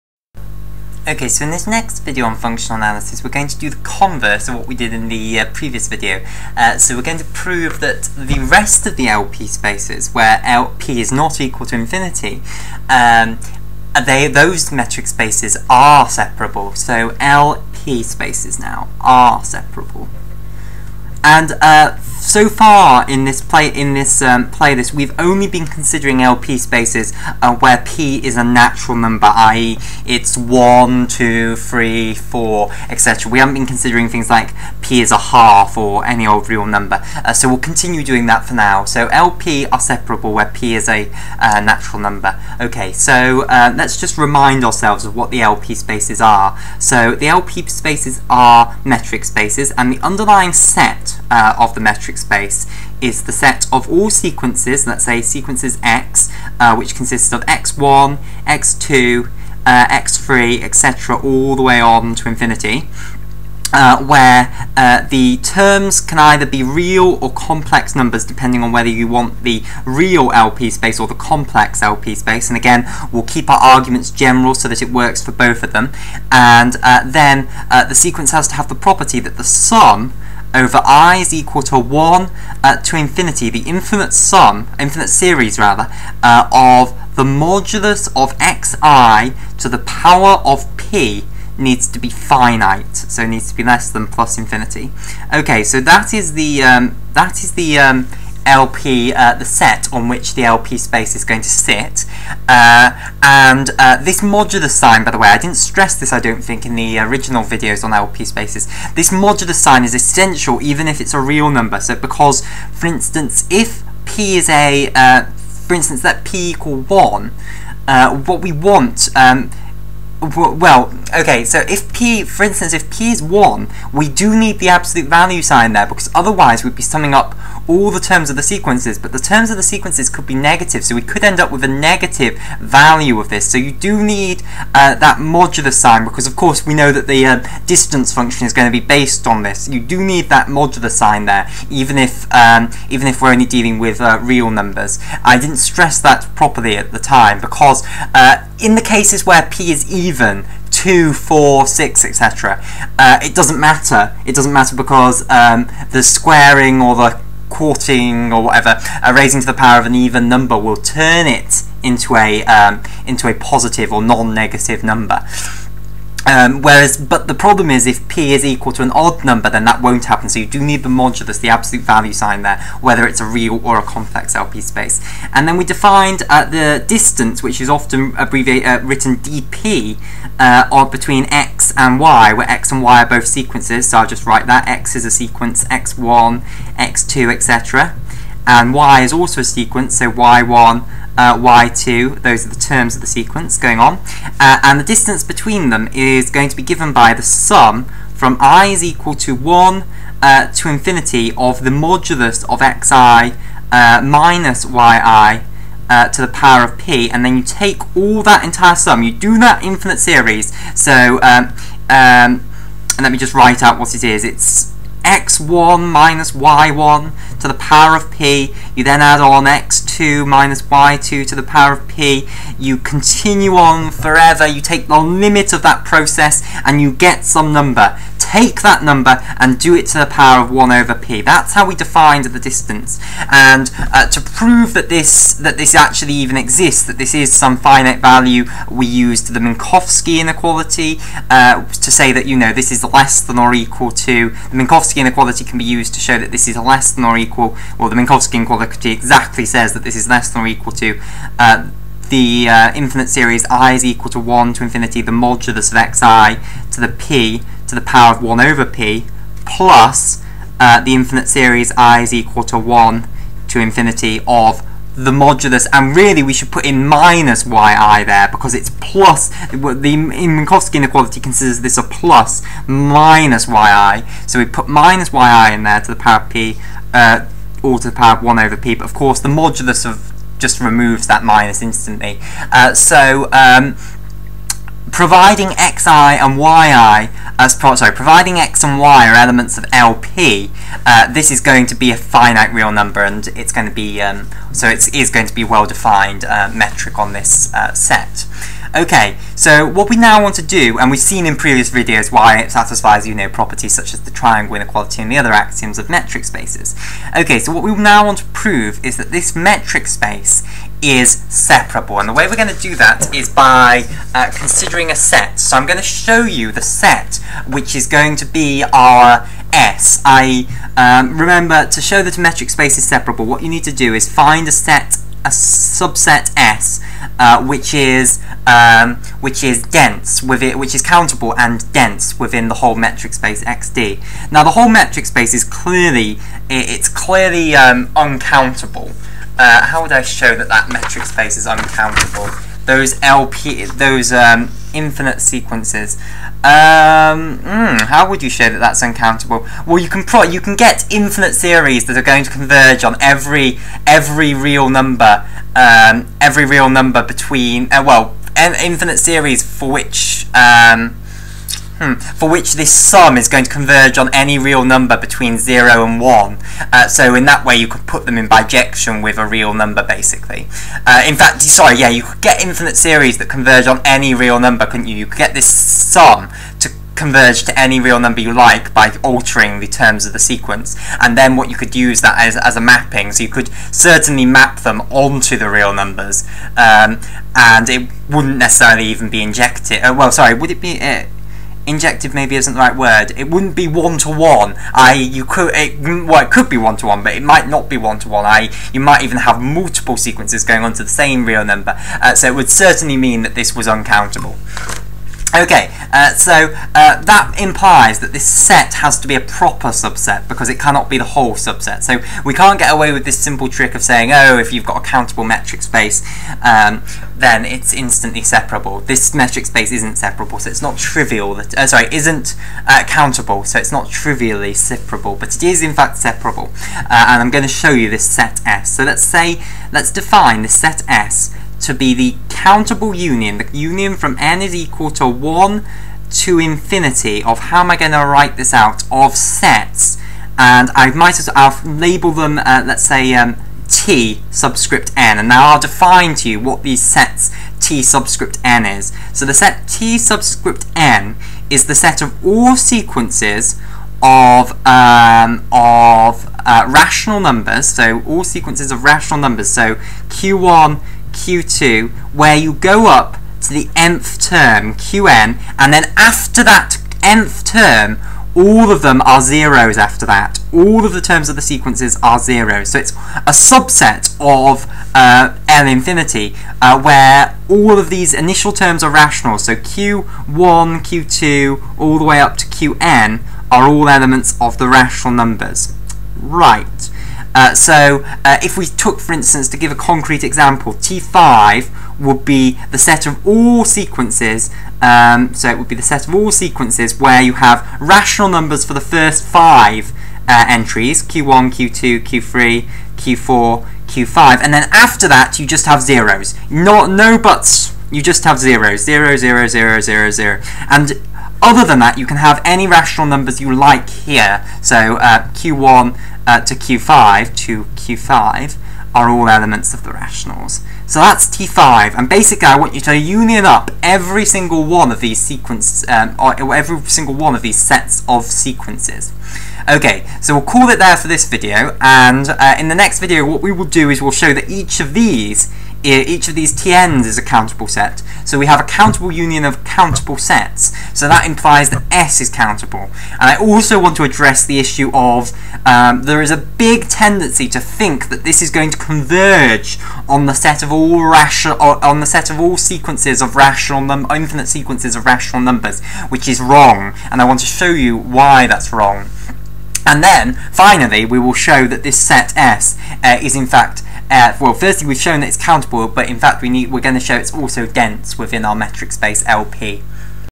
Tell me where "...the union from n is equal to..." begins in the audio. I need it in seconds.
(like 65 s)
433 s.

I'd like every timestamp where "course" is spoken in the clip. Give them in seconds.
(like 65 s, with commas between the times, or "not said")
136 s, 278 s.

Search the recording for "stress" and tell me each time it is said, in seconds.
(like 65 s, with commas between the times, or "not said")
105 s, 145 s.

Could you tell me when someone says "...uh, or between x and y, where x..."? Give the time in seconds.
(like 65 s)
180 s.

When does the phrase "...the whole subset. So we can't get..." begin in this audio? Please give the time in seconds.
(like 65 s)
410 s.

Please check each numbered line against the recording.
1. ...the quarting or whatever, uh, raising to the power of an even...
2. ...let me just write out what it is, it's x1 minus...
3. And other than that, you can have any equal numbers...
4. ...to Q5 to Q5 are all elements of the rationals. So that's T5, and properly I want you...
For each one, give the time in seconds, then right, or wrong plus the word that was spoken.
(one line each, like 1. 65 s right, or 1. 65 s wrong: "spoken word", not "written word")
1. 156 s right
2. 213 s right
3. 510 s wrong: "rational", not "equal"
4. 516 s wrong: "basically", not "properly".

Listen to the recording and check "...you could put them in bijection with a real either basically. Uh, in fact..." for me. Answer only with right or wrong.
wrong.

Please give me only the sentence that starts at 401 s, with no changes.
Uh, so it would certainly mean that this was uncountable.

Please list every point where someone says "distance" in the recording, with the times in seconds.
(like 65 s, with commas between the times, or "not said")
137 s, 176 s, 194 s, 232 s.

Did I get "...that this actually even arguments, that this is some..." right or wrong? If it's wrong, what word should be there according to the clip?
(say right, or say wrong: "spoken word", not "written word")
wrong: "exists", not "arguments".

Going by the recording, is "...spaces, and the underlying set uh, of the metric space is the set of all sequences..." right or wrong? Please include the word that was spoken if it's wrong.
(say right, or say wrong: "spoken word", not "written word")
right.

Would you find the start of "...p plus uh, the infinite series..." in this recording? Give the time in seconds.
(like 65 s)
258 s.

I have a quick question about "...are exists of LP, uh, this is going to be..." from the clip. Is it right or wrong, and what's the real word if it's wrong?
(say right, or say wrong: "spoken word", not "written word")
wrong: "elements", not "exists".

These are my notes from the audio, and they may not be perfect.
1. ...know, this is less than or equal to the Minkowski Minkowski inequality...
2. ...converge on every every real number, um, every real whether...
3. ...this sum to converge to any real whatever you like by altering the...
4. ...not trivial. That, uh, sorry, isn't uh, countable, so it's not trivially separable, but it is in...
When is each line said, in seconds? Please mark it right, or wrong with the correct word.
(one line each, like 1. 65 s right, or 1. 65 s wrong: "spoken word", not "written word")
1. 242 s right
2. 352 s wrong: "number", not "whether"
3. 375 s wrong: "number", not "whatever"
4. 420 s right.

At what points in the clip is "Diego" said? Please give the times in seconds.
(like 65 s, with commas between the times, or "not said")
not said.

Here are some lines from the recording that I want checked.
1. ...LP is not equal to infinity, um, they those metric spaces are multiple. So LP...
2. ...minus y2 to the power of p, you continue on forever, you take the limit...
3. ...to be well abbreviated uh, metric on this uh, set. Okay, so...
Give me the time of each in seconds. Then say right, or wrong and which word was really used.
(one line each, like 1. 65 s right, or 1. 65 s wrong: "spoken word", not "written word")
1. 10 s wrong: "separable", not "multiple"
2. 220 s right
3. 295 s wrong: "defined", not "abbreviated".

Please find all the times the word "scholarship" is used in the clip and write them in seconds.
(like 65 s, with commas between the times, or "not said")
not said.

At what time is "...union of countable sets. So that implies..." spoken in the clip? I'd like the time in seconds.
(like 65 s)
539 s.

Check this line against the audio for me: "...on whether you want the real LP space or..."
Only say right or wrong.
right.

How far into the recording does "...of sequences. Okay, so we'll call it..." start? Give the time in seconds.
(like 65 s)
528 s.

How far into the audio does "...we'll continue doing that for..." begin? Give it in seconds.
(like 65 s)
37 s.